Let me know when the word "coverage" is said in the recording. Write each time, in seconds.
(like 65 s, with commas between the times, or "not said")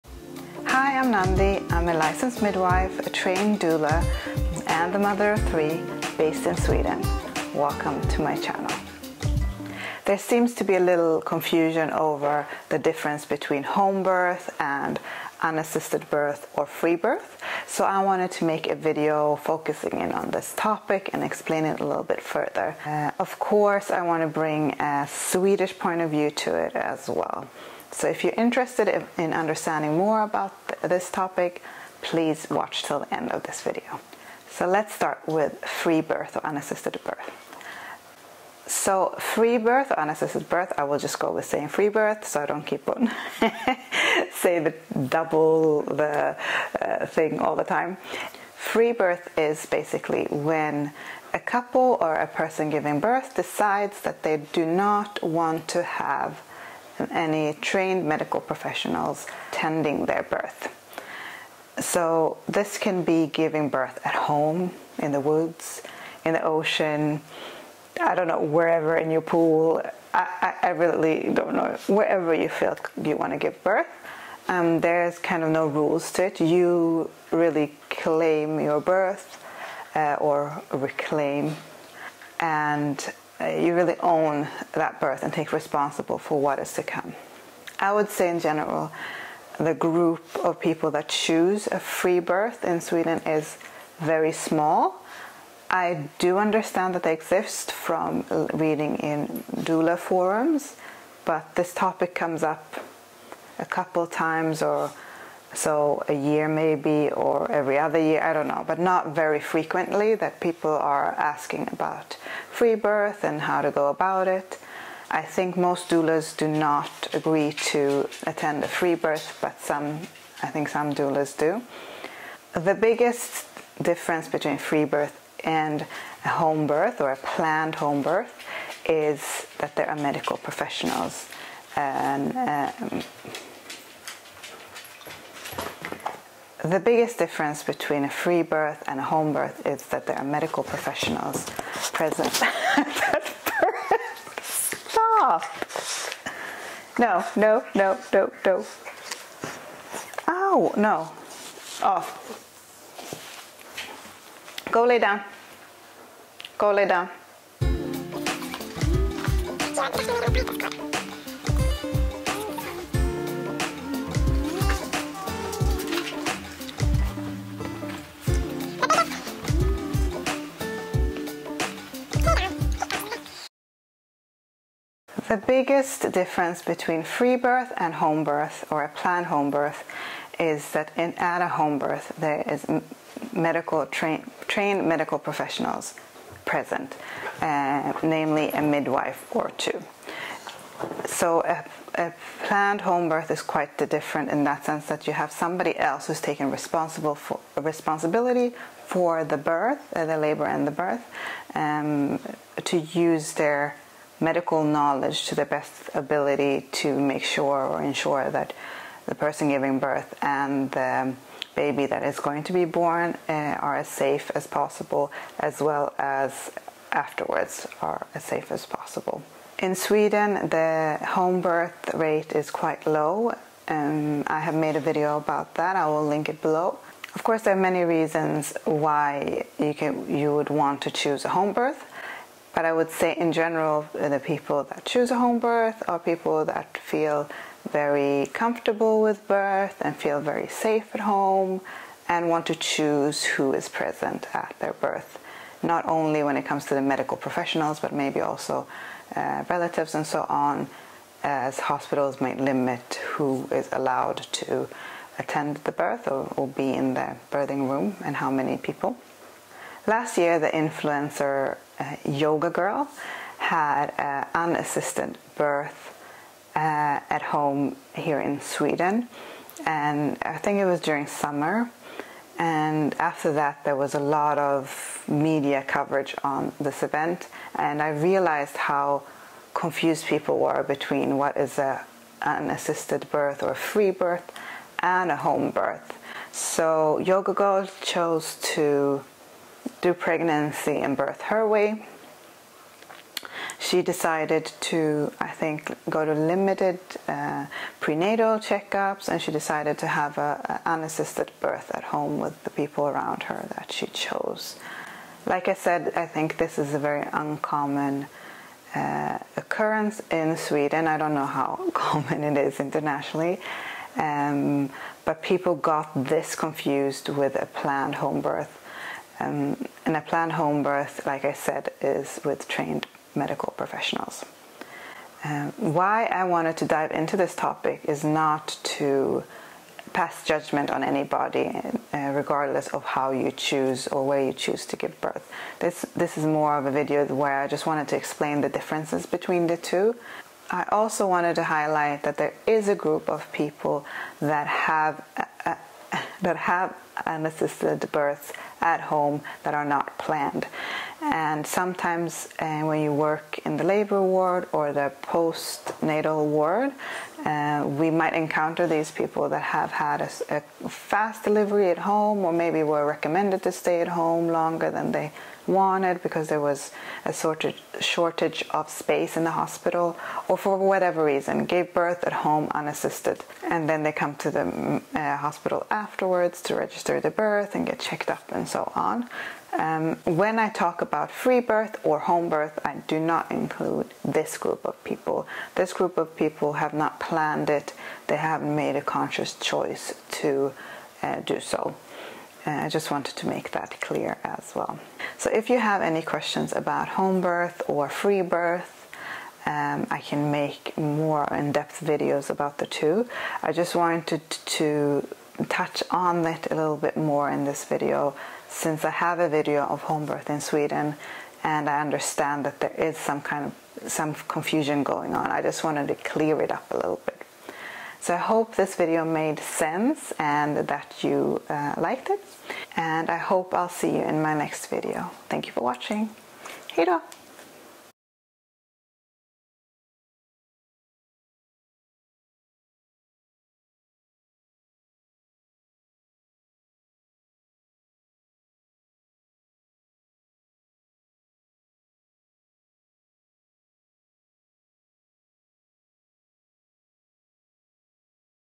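275 s.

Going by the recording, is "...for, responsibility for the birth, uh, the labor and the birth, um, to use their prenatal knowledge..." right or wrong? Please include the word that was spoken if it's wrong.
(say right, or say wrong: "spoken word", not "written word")
wrong: "medical", not "prenatal".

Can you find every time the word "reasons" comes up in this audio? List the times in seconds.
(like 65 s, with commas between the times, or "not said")
227 s, 371 s.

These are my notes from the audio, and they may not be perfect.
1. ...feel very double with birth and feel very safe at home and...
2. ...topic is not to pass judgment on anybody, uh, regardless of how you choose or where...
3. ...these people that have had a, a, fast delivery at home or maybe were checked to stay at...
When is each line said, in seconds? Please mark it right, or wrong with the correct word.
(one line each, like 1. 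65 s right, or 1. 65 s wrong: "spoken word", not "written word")
1. 236 s wrong: "comfortable", not "double"
2. 327 s right
3. 358 s wrong: "recommended", not "checked".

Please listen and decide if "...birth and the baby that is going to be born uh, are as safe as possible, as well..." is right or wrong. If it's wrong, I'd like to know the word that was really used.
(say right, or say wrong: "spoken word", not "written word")
right.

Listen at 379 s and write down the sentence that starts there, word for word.
Um, when I talk about free birth or home birth, I do not include this group of people.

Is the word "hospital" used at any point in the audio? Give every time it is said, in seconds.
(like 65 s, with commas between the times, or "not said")
251 s, 369 s, 375 s.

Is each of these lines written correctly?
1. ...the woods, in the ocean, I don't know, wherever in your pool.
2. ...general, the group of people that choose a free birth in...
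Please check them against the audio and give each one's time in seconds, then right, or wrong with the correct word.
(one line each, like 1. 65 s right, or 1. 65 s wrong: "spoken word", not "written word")
1. 65 s right
2. 88 s right.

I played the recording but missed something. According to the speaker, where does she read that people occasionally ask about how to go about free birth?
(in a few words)
doula forums.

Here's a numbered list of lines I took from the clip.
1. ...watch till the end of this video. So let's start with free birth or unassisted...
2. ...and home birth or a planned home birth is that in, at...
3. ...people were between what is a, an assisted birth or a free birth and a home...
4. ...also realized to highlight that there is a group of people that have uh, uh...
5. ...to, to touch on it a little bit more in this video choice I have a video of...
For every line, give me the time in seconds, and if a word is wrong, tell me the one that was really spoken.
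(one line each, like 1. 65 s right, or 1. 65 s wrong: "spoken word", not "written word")
1. 32 s right
2. 177 s right
3. 280 s right
4. 340 s wrong: "wanted", not "realized"
5. 404 s wrong: "since", not "choice".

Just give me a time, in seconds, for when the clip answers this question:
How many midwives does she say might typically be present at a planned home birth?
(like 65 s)
188 s.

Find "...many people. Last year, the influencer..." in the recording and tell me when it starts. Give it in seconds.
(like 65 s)
258 s.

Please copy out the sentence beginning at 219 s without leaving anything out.
In Sweden, the home birth rate is quite low.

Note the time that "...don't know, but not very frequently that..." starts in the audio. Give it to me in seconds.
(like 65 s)
108 s.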